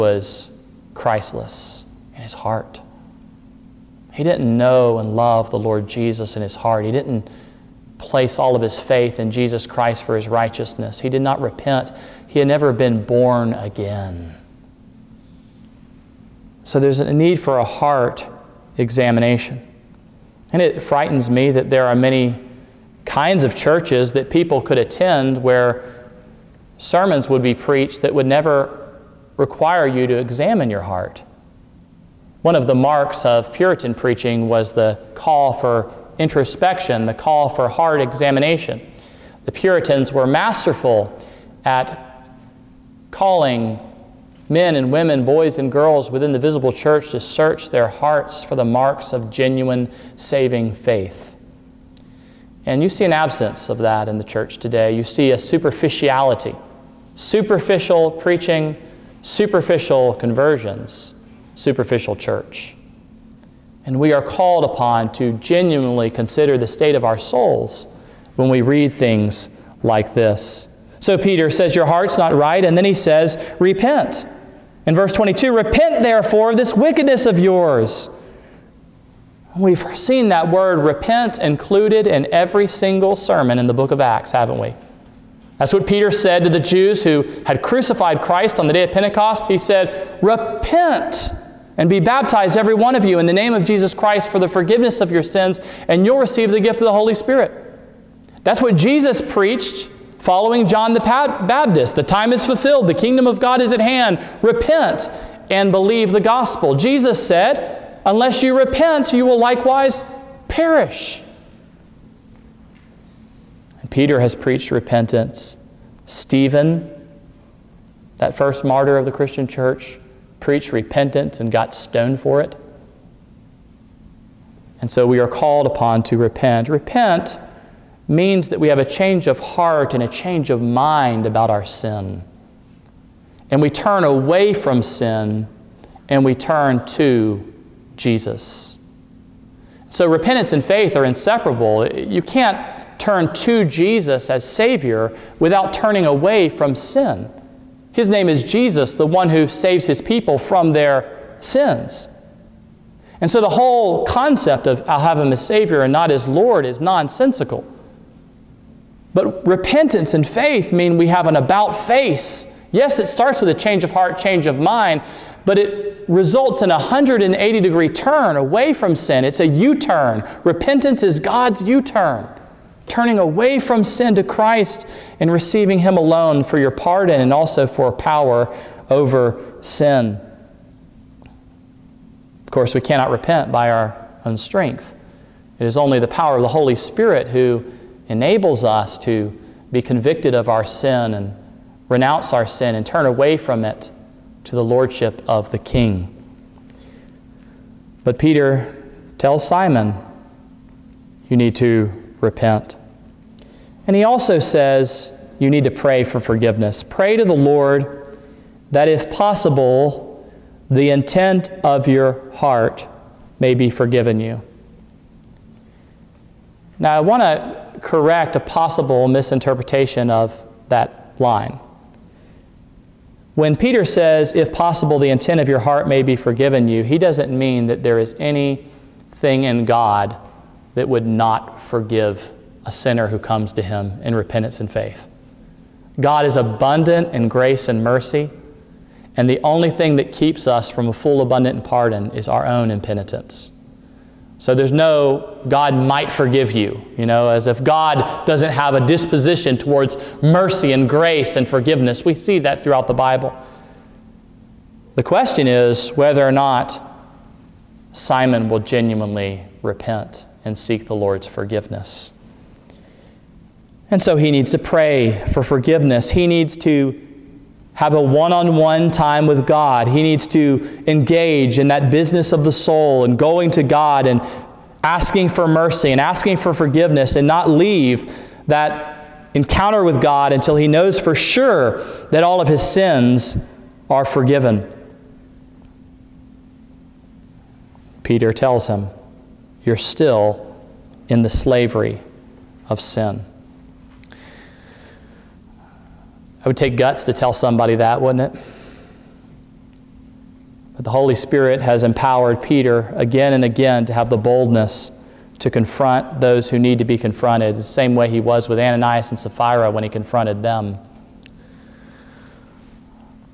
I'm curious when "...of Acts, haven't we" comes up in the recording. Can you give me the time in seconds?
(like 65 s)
83 s.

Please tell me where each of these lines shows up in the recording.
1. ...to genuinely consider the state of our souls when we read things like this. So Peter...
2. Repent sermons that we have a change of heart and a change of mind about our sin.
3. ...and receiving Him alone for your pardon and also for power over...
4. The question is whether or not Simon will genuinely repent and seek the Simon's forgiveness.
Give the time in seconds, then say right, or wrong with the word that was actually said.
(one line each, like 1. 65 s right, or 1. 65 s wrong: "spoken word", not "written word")
1. 65 s right
2. 126 s wrong: "means", not "sermons"
3. 175 s right
4. 254 s wrong: "Lord", not "Simon".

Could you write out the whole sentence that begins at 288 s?
Peter tells him, you're still in the slavery of sin.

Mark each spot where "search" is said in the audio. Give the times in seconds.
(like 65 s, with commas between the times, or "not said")
47 s.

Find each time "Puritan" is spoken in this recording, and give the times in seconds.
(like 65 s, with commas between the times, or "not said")
33 s, 39 s.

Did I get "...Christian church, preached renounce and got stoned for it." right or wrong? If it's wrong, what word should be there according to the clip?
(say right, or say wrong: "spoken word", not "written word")
wrong: "repentance", not "renounce".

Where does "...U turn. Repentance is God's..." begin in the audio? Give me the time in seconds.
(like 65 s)
169 s.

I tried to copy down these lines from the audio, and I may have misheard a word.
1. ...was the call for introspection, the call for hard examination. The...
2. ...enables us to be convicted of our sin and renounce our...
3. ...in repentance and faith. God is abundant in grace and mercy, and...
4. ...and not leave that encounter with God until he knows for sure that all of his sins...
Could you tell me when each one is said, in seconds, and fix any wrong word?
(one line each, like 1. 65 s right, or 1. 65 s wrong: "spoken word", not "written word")
1. 34 s right
2. 188 s right
3. 234 s right
4. 277 s right.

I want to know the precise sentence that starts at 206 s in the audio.
Pray to the Lord that, if possible, the intent of your heart may be forgiven you.